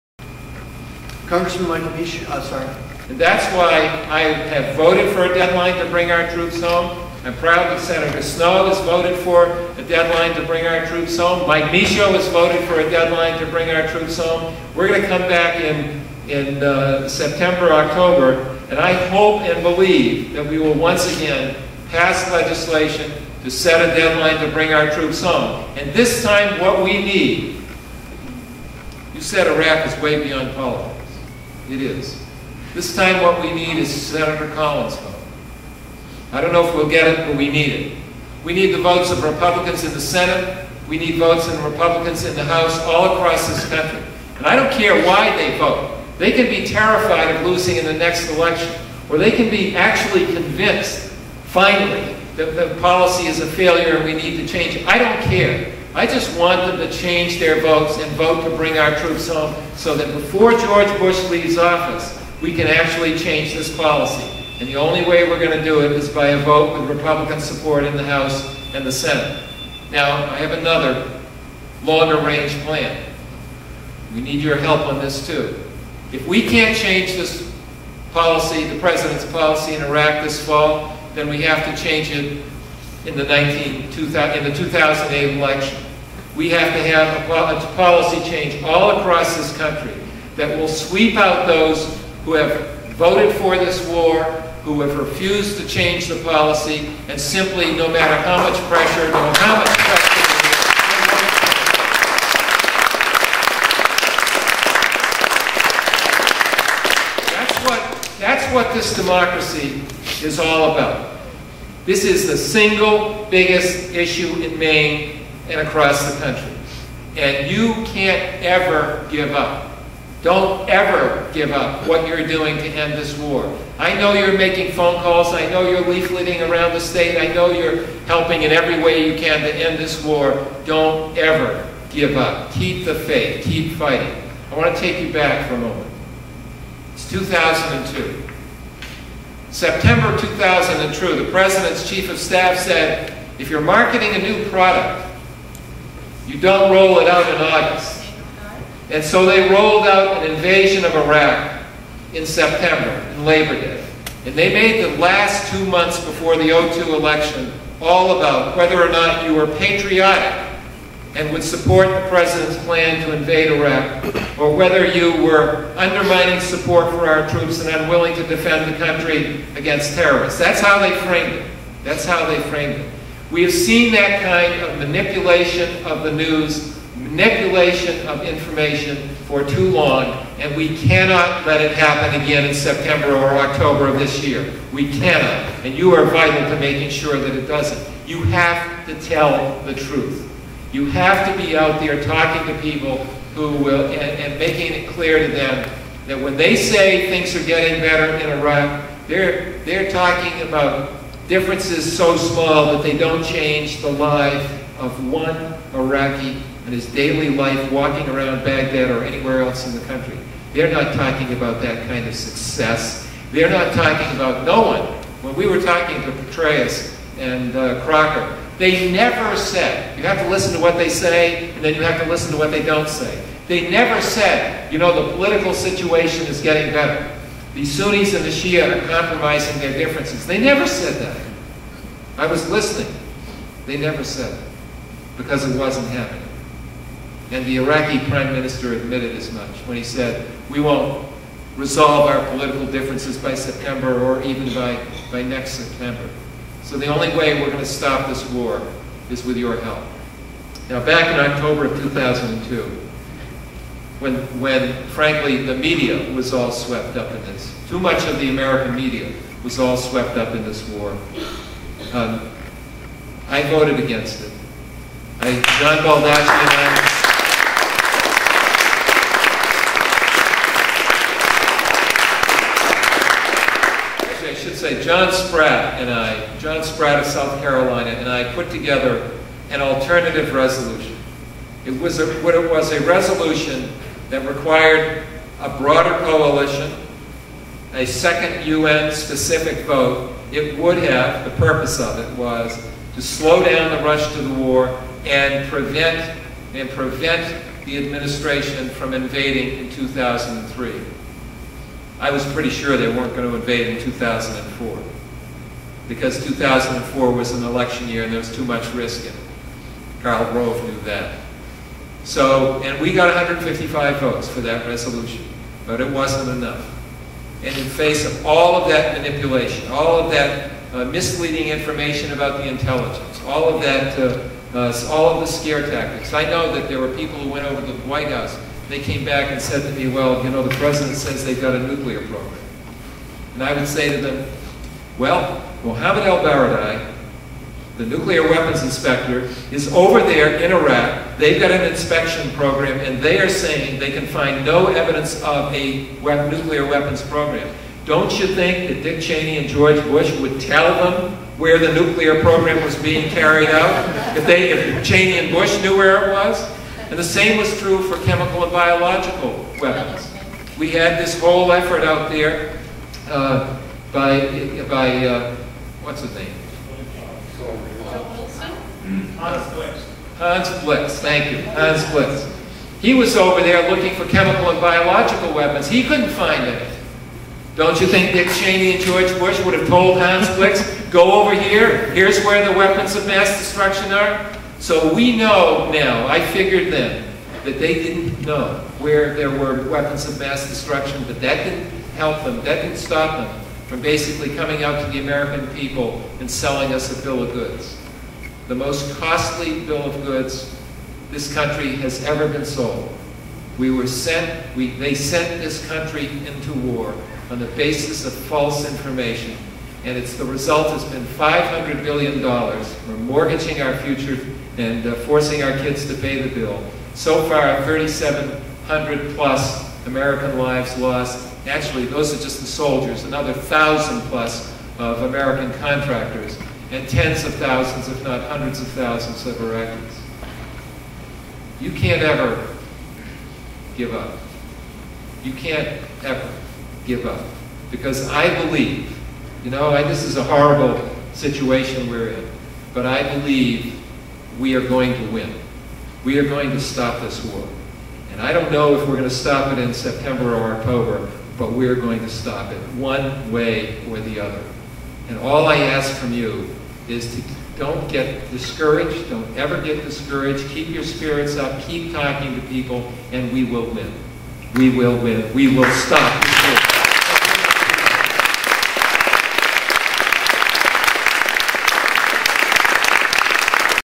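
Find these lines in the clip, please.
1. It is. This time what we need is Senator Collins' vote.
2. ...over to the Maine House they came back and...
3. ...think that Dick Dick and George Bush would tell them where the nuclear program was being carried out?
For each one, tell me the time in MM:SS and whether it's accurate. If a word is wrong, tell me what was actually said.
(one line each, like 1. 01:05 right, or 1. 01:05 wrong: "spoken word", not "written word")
1. 00:31 right
2. 05:27 wrong: "White", not "Maine"
3. 05:48 wrong: "Cheney", not "Dick".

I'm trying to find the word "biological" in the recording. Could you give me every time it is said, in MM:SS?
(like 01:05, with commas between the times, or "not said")
05:58, 06:14.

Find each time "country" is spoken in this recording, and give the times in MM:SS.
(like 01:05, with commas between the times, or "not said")
00:43, 01:29, 01:56, 02:48, 03:29, 06:41, 06:45.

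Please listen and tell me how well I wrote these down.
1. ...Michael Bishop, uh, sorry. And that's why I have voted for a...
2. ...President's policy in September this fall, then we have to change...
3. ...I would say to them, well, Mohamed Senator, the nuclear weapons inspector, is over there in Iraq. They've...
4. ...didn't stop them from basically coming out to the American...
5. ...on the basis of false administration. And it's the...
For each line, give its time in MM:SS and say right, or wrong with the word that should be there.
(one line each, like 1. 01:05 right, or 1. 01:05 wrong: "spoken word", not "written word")
1. 00:01 right
2. 01:18 wrong: "Iraq", not "September"
3. 05:33 wrong: "ElBaradei", not "Senator"
4. 06:32 right
5. 06:47 wrong: "information", not "administration".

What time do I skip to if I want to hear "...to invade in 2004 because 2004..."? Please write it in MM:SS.
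05:03.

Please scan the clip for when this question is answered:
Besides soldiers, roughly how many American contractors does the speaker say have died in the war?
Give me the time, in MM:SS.
07:03.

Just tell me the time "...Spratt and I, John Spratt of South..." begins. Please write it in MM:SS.
04:35.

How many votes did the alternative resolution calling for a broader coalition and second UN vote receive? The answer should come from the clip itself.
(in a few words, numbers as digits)
155.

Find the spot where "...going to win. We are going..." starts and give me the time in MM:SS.
07:24.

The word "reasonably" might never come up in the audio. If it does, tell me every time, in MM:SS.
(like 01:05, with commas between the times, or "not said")
not said.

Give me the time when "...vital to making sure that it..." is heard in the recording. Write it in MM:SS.
03:06.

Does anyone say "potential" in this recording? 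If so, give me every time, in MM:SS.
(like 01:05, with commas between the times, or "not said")
not said.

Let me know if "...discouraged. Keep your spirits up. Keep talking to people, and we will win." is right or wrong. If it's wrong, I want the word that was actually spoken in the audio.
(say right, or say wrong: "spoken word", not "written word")
right.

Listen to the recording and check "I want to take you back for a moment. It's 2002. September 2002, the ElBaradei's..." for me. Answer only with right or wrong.
wrong.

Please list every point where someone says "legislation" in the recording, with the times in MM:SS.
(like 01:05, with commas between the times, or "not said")
00:22.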